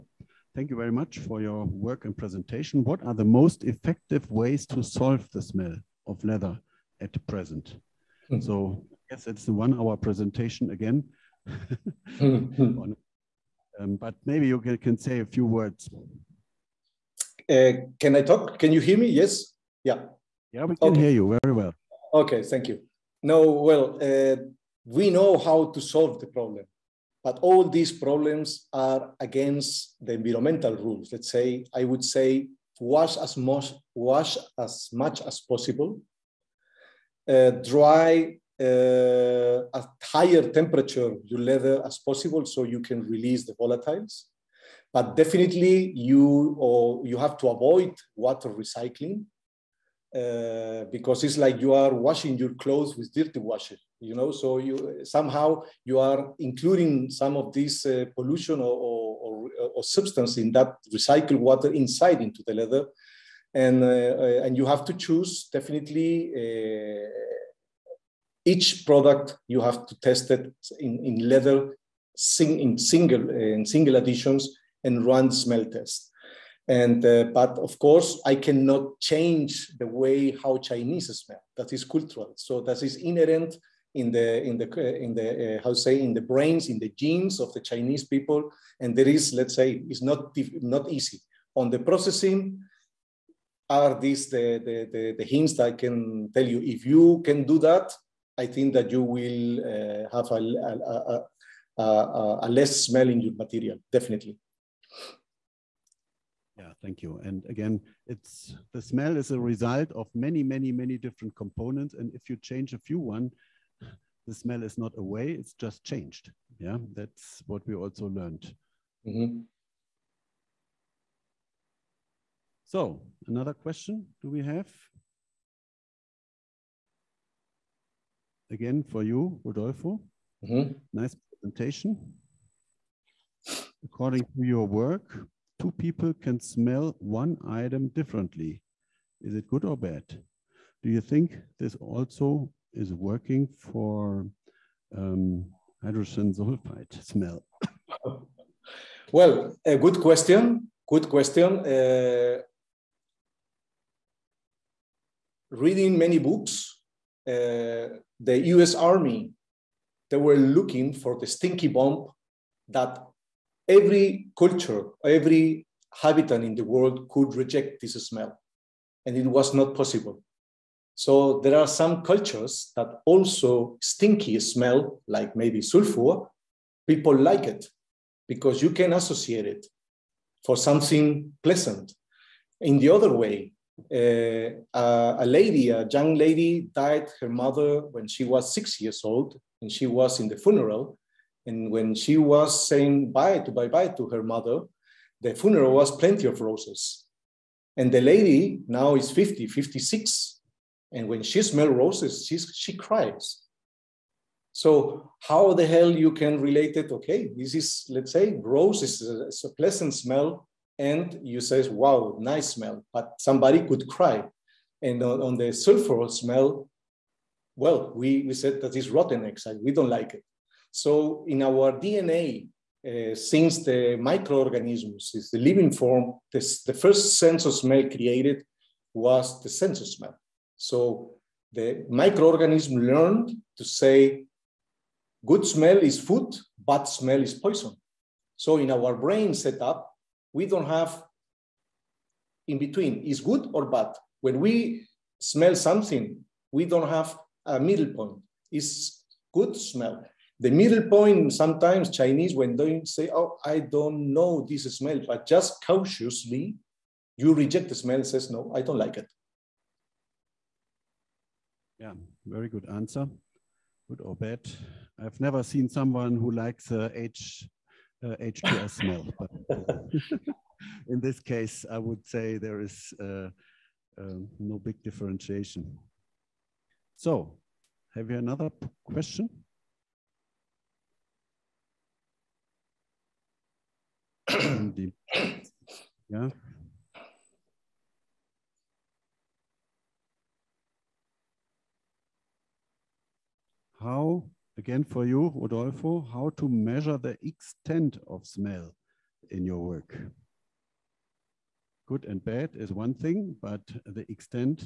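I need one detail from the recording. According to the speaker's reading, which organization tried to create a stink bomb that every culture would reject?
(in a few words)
US Army.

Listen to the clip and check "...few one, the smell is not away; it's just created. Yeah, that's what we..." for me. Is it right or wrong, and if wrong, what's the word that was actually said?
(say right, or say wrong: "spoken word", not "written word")
wrong: "changed", not "created".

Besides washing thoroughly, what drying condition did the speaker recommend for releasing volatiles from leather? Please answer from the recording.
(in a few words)
higher temperature.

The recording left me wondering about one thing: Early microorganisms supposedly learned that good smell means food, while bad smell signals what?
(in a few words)
poison.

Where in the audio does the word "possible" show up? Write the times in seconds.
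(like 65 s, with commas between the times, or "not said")
35 s, 41 s, 169 s.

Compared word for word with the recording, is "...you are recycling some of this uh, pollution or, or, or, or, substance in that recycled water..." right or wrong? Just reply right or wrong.
wrong.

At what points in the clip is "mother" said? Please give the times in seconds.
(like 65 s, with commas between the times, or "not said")
187 s, 194 s.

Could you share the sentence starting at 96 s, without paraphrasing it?
If you can do that, I think that you will uh, have a, a, a, a, less smell in your material, definitely.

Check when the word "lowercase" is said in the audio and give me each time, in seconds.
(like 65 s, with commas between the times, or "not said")
not said.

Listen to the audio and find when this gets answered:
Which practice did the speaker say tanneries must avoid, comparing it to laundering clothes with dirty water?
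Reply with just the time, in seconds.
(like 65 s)
48 s.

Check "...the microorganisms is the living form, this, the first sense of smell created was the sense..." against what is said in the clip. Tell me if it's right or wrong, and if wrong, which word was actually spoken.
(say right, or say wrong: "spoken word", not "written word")
right.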